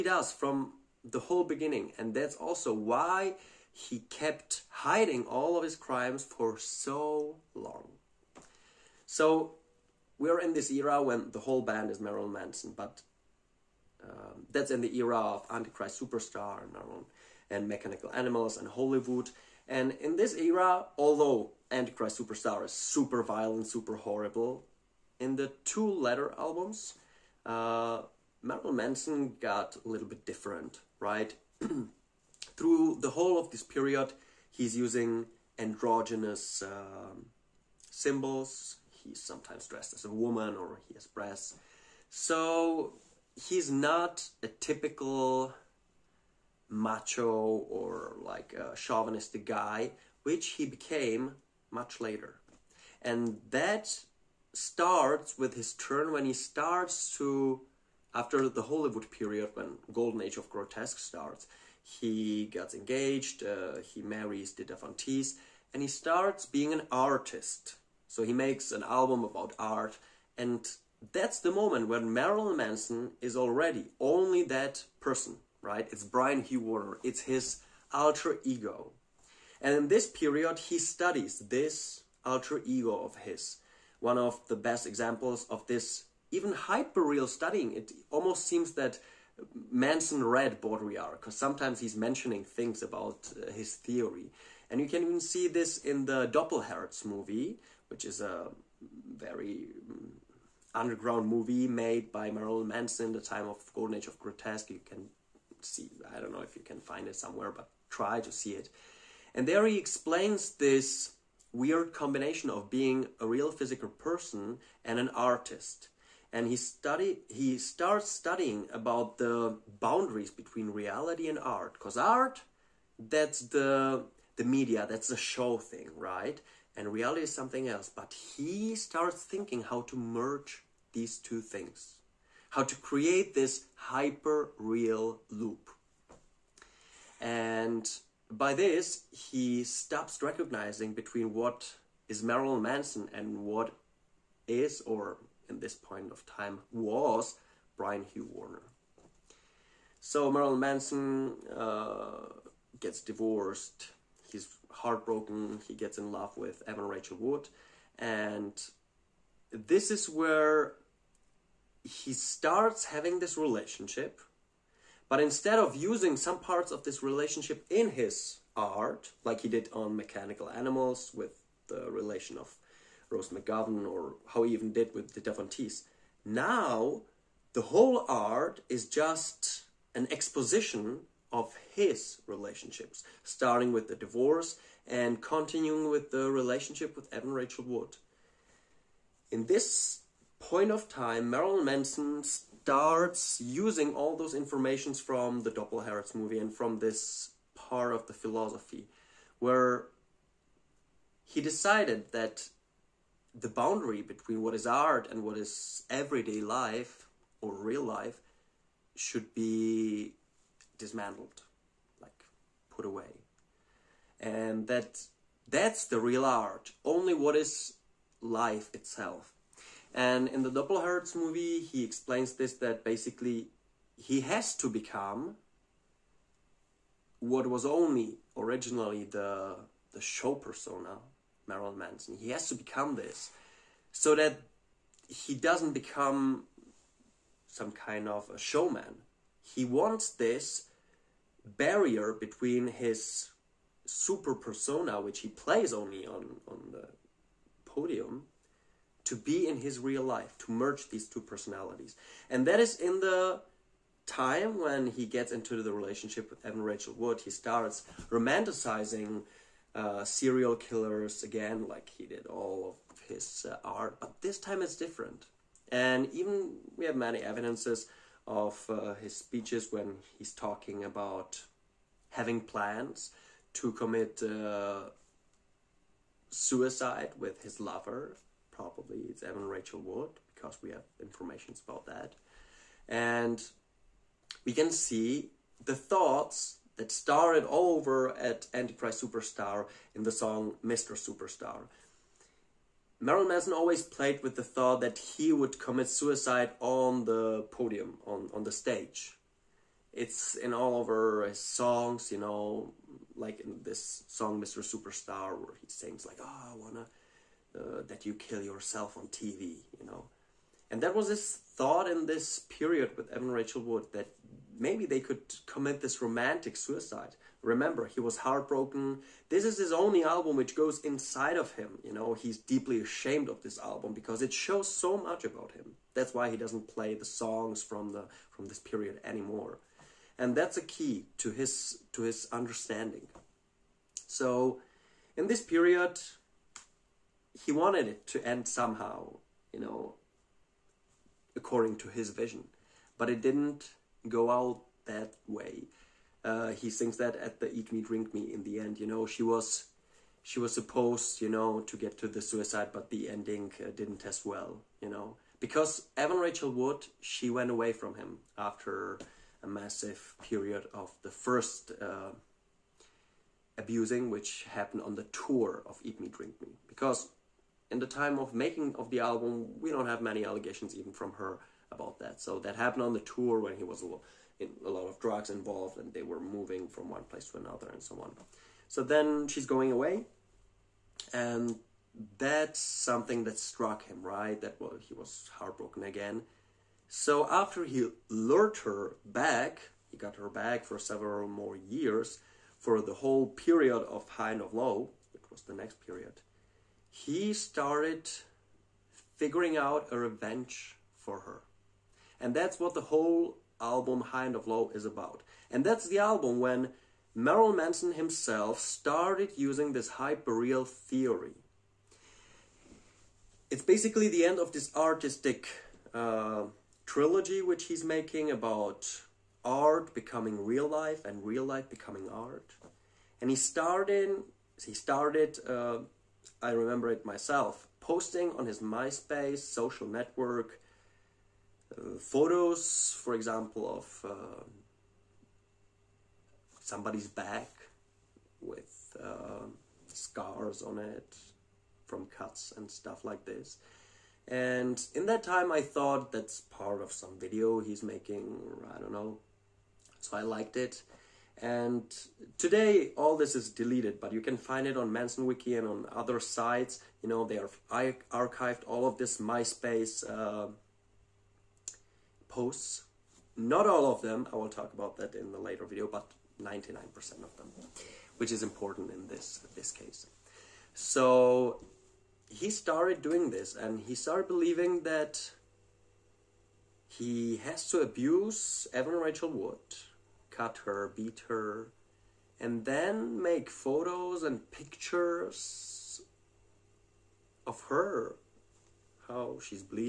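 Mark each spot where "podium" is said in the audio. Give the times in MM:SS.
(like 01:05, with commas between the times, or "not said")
04:07, 04:57.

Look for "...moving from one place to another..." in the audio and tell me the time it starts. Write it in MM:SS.
06:16.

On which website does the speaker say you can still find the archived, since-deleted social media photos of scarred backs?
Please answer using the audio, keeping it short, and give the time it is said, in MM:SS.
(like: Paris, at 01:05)
Manson Wiki, at 07:34.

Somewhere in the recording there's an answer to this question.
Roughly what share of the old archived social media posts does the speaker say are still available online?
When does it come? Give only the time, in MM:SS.
07:46.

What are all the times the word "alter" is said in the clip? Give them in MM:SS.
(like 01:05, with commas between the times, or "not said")
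01:17, 01:22.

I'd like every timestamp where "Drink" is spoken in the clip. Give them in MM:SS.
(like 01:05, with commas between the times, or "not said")
05:47, 06:06.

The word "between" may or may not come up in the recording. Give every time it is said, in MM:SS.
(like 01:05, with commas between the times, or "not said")
02:00, 02:20, 03:24, 04:02.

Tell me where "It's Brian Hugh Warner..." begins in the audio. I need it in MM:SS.
01:15.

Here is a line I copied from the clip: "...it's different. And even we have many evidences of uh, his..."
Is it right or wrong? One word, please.
right.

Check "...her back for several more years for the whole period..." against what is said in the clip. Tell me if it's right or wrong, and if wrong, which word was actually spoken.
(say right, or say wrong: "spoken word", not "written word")
right.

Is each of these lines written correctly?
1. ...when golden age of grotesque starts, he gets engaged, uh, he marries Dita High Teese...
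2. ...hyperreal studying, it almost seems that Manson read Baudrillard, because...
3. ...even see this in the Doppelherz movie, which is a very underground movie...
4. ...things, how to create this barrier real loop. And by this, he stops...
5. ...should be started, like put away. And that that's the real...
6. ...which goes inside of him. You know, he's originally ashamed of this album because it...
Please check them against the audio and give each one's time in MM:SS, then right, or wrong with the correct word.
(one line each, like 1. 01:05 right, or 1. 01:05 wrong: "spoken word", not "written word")
1. 00:59 wrong: "Von", not "High"
2. 01:26 right
3. 01:35 right
4. 02:11 wrong: "hyper", not "barrier"
5. 03:28 wrong: "dismantled", not "started"
6. 05:20 wrong: "deeply", not "originally".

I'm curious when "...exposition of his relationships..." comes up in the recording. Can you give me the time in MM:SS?
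03:00.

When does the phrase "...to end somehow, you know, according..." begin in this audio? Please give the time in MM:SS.
05:38.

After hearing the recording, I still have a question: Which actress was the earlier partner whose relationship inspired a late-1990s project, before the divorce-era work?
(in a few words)
Rose McGowan.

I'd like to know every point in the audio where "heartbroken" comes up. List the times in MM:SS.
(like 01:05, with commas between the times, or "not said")
02:34, 05:18, 06:25.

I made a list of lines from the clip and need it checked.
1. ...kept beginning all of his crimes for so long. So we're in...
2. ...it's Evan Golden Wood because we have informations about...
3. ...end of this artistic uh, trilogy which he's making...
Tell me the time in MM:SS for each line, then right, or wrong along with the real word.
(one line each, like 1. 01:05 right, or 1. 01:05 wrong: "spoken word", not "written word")
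1. 00:04 wrong: "hiding", not "beginning"
2. 04:39 wrong: "Rachel", not "Golden"
3. 06:54 right.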